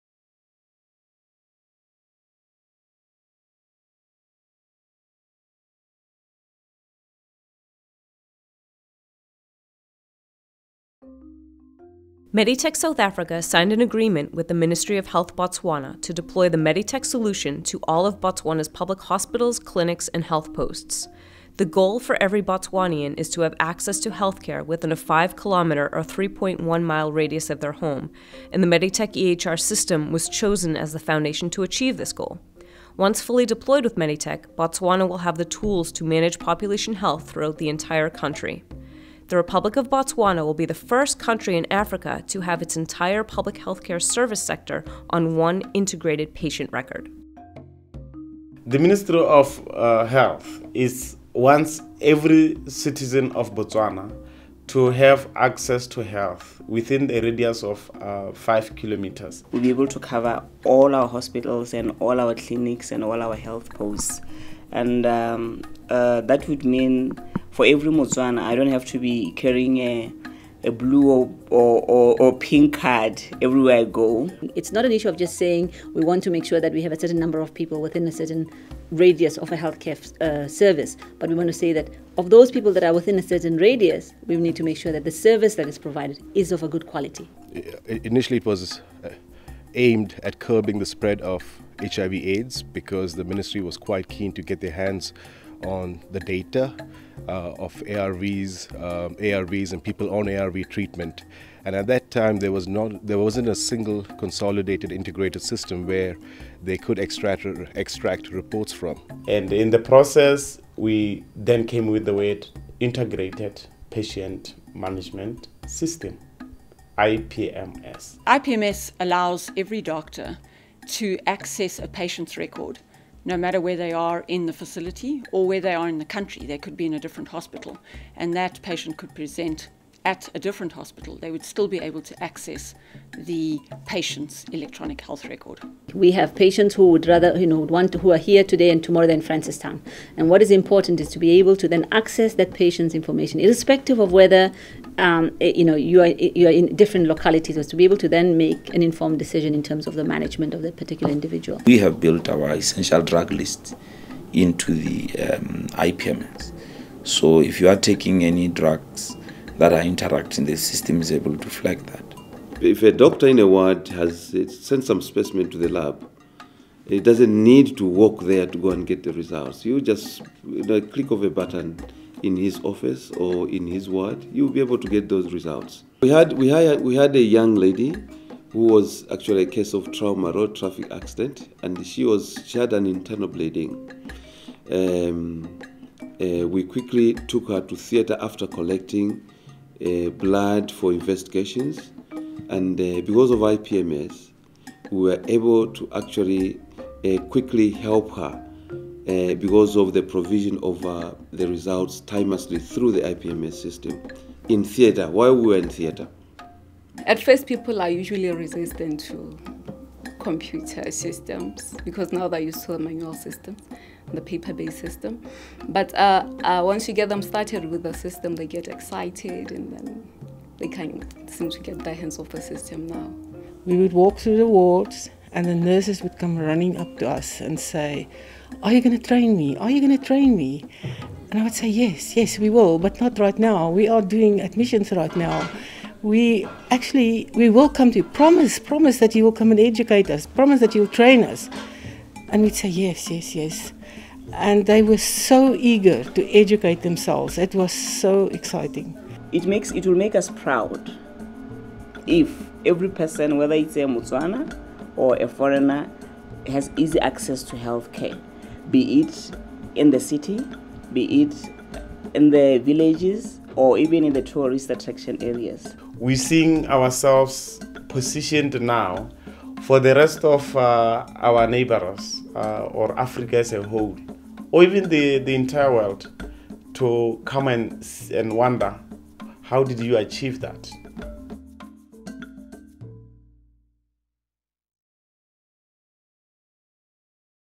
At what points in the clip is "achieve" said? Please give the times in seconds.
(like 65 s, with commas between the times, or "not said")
31 s, 279 s.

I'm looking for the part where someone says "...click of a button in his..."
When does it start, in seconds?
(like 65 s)
170 s.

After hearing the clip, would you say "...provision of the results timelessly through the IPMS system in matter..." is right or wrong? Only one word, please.
wrong.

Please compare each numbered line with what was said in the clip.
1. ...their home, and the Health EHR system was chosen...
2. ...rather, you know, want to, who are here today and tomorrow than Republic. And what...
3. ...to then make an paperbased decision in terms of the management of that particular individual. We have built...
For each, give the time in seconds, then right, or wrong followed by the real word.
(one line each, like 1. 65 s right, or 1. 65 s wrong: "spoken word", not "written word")
1. 27 s wrong: "Meditech", not "Health"
2. 137 s wrong: "Francistown", not "Republic"
3. 147 s wrong: "informed", not "paperbased".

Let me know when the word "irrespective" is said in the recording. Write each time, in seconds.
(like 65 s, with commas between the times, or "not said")
143 s.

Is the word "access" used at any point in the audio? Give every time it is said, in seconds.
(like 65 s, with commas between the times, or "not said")
23 s, 55 s, 121 s, 132 s, 141 s, 257 s.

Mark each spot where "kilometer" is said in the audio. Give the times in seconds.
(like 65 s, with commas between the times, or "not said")
25 s, 58 s.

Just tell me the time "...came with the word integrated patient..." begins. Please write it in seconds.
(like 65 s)
111 s.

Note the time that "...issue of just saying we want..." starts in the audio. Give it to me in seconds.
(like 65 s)
74 s.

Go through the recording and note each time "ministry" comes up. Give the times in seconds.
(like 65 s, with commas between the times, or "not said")
14 s, 48 s, 93 s.